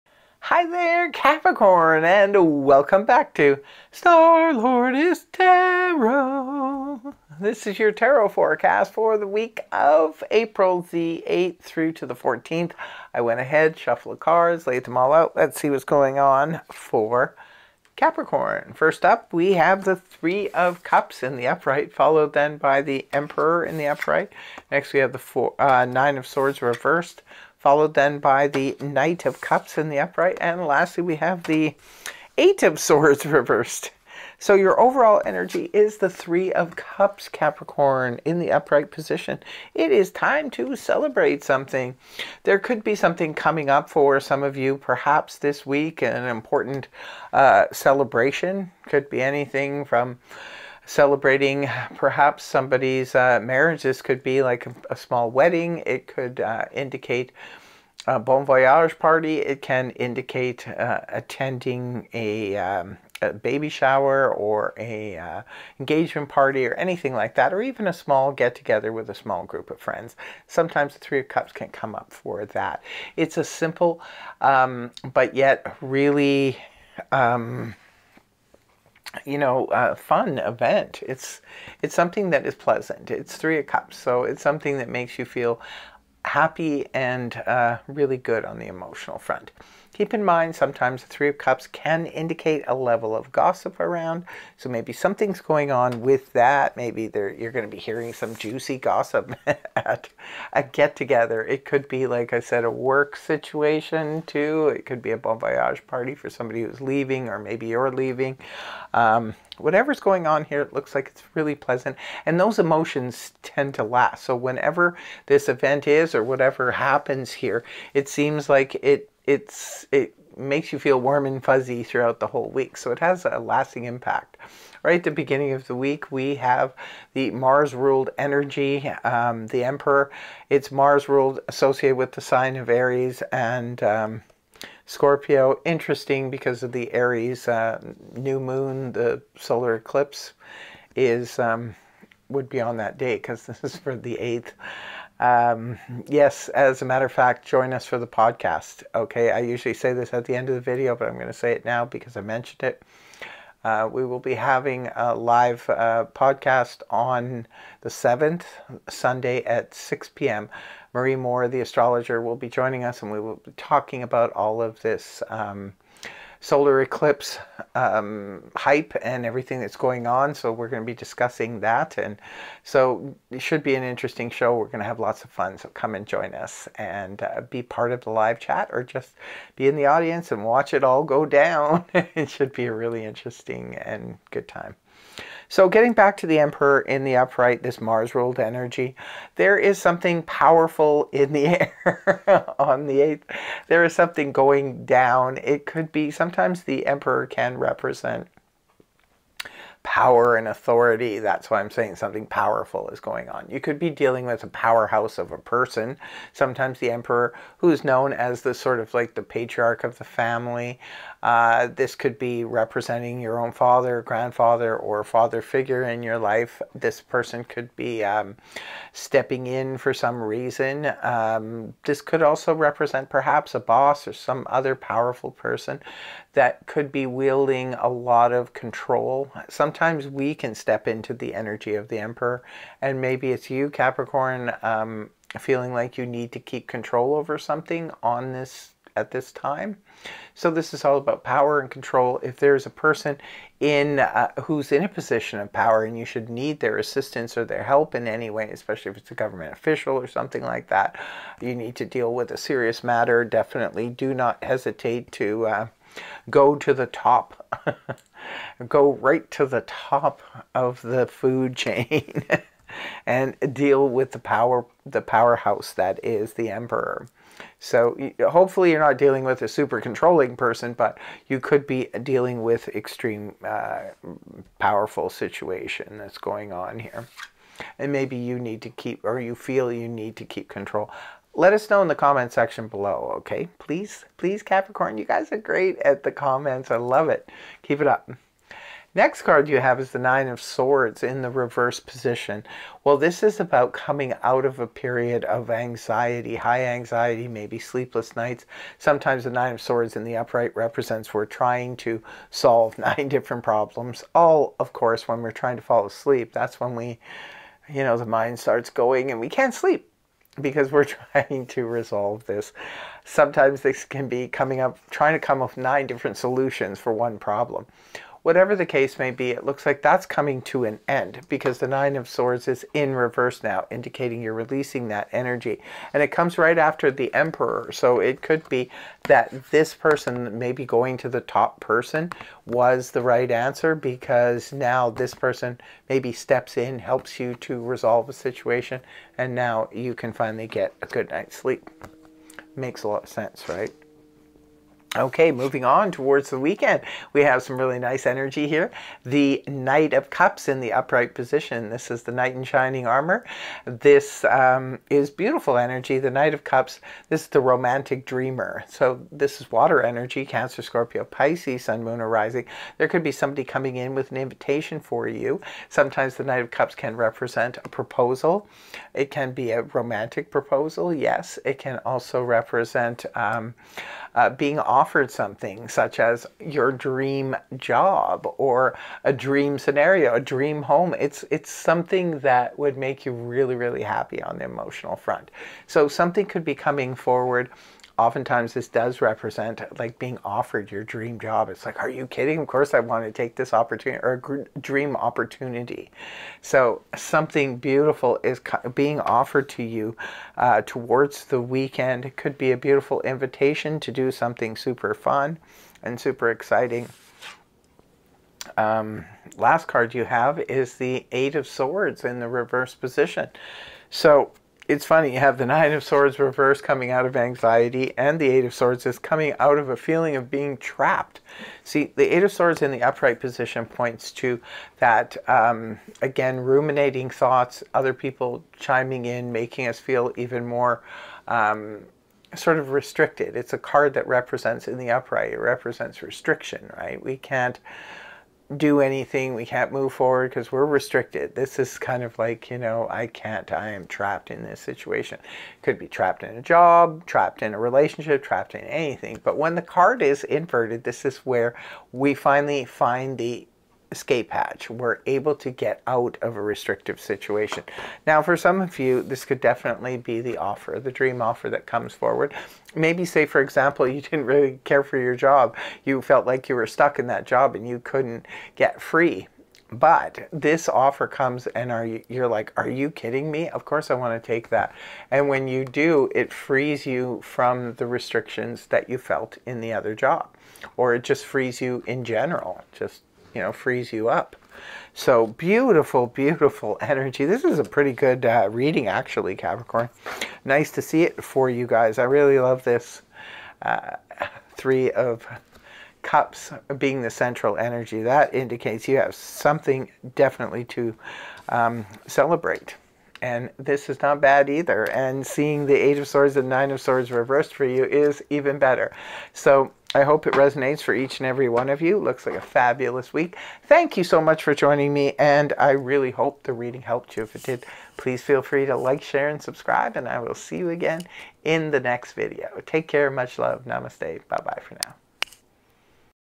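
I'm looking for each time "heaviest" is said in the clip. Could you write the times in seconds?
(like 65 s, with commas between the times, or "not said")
not said.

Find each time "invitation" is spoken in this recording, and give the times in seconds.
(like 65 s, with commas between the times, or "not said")
364 s, 403 s.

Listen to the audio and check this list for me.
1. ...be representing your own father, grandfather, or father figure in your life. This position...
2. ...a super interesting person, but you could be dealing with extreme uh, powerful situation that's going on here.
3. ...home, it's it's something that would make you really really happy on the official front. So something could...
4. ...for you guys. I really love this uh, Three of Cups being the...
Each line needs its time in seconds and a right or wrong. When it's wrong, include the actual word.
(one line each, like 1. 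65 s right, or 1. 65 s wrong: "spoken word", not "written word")
1. 212 s wrong: "person", not "position"
2. 269 s wrong: "controlling", not "interesting"
3. 380 s wrong: "emotional", not "official"
4. 491 s right.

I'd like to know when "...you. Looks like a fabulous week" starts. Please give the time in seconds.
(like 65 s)
511 s.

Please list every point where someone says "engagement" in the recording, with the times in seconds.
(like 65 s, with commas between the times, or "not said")
65 s.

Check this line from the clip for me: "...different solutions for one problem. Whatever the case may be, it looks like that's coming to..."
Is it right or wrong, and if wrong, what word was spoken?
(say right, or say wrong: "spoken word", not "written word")
right.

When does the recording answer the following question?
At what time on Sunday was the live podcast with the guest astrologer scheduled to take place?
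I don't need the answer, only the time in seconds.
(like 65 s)
159 s.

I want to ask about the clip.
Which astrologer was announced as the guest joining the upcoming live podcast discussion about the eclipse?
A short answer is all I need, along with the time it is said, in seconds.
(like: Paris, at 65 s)
Marie Moore, at 160 s.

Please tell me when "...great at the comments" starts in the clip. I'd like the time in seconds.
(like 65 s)
285 s.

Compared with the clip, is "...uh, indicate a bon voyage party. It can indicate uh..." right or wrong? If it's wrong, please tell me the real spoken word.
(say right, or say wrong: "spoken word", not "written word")
right.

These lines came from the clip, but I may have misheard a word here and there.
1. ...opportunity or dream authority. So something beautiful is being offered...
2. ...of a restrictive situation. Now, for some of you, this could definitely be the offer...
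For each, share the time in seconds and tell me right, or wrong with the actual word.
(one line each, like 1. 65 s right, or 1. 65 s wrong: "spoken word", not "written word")
1. 393 s wrong: "opportunity", not "authority"
2. 456 s right.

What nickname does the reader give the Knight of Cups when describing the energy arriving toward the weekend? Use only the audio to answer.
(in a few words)
Knight in Shining Armor.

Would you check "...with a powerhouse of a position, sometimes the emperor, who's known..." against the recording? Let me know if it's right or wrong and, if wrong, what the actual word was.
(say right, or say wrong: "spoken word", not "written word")
wrong: "person", not "position".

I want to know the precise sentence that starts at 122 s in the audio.
So it has a lasting impact.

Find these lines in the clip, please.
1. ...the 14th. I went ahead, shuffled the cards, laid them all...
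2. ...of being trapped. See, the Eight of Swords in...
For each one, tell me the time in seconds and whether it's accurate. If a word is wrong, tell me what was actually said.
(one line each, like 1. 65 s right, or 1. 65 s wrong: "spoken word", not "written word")
1. 12 s right
2. 420 s right.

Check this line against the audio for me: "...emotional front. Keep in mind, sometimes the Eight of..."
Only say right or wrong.
wrong.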